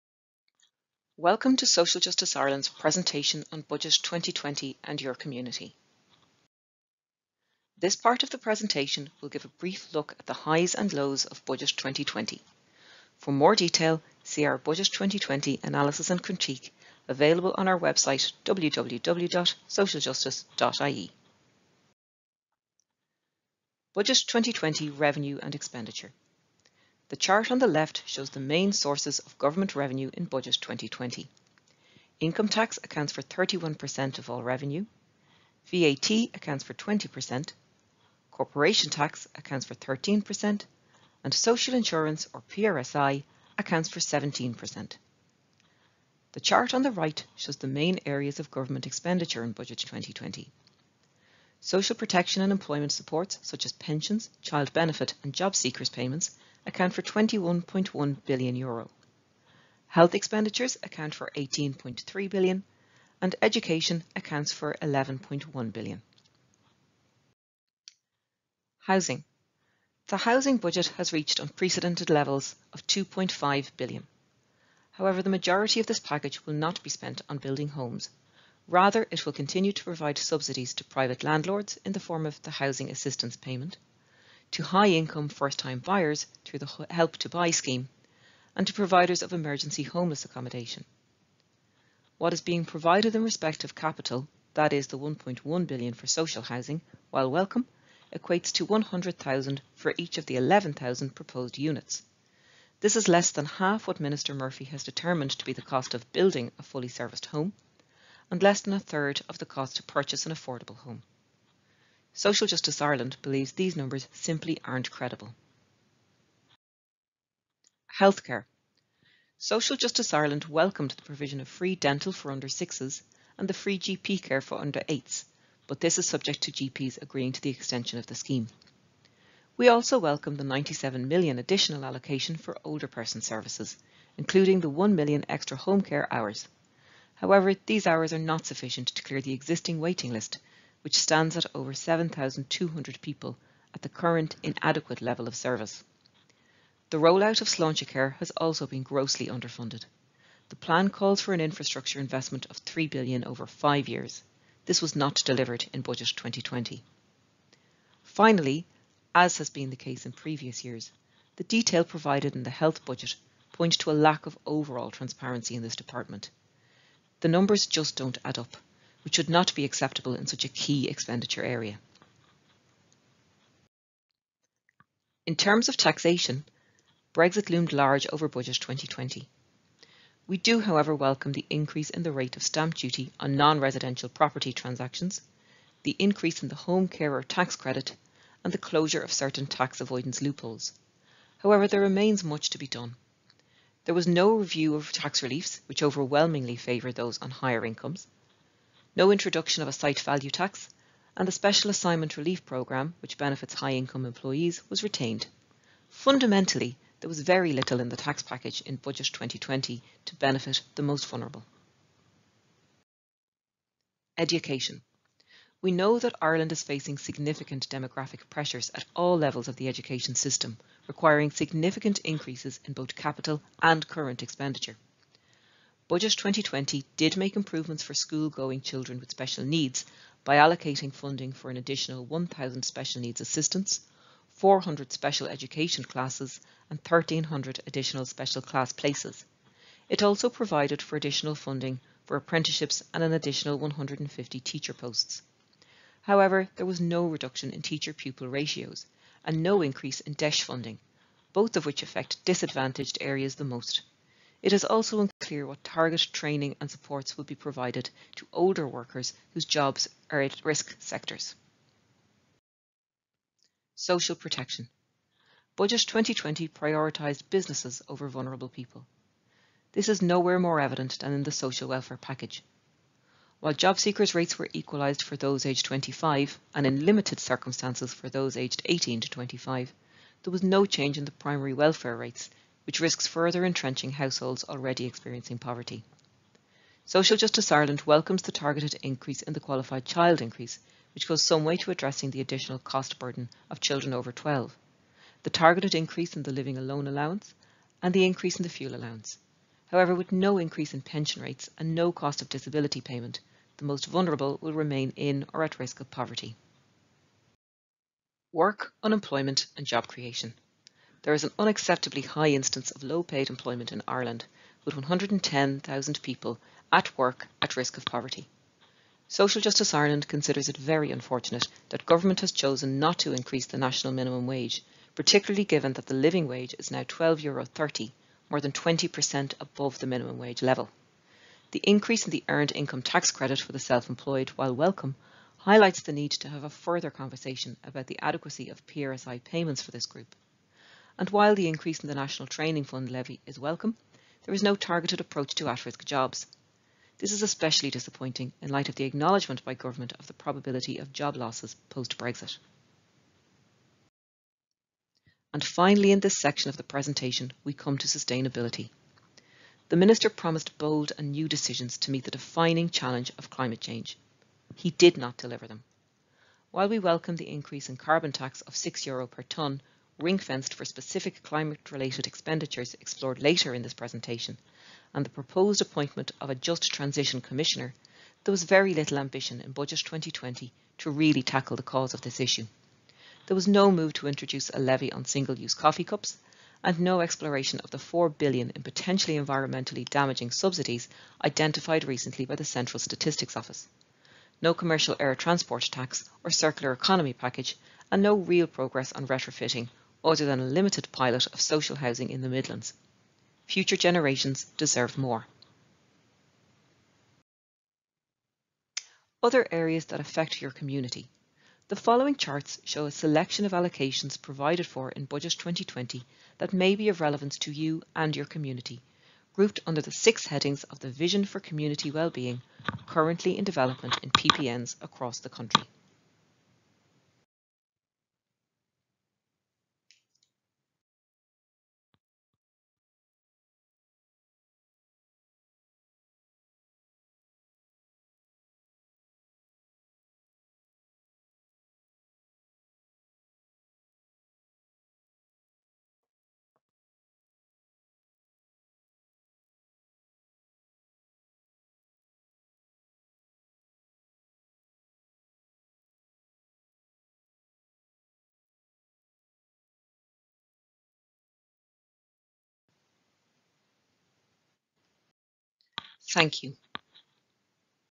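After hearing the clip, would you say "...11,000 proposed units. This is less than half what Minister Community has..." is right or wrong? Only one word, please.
wrong.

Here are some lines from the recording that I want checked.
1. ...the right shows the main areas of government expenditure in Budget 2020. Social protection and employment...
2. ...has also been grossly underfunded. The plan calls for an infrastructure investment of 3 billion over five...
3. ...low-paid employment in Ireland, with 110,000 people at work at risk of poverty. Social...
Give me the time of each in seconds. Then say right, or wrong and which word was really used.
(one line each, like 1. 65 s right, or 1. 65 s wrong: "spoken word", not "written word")
1. 46 s right
2. 148 s right
3. 312 s right.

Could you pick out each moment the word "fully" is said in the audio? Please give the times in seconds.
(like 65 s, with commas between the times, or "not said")
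106 s.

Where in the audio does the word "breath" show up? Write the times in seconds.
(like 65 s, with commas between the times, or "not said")
not said.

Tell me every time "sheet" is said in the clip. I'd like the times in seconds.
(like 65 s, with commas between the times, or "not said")
not said.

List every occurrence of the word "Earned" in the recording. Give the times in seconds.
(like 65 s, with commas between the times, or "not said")
332 s.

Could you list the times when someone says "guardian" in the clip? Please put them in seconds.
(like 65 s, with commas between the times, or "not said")
not said.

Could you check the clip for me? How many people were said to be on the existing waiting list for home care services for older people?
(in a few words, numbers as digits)
over 7,200.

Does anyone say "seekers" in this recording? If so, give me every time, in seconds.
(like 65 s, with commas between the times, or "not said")
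55 s, 273 s.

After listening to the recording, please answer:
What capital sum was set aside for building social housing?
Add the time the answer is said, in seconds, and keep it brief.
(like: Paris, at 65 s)
1.1 billion, at 94 s.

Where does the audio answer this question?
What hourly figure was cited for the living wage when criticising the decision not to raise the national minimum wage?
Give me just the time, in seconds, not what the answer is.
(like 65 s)
326 s.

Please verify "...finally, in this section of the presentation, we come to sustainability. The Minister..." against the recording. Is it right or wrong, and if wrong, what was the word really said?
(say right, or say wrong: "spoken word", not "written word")
right.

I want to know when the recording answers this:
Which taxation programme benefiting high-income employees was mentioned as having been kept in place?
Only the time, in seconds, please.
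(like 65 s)
201 s.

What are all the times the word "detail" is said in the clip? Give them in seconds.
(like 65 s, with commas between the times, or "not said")
13 s, 161 s.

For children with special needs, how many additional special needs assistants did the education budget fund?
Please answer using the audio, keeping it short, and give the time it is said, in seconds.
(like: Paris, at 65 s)
1,000, at 231 s.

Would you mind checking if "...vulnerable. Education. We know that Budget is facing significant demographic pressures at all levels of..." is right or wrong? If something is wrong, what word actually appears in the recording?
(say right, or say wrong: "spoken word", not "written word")
wrong: "Ireland", not "Budget".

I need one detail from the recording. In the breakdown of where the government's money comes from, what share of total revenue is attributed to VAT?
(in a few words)
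20%.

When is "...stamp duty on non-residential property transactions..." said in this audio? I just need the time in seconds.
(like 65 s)
182 s.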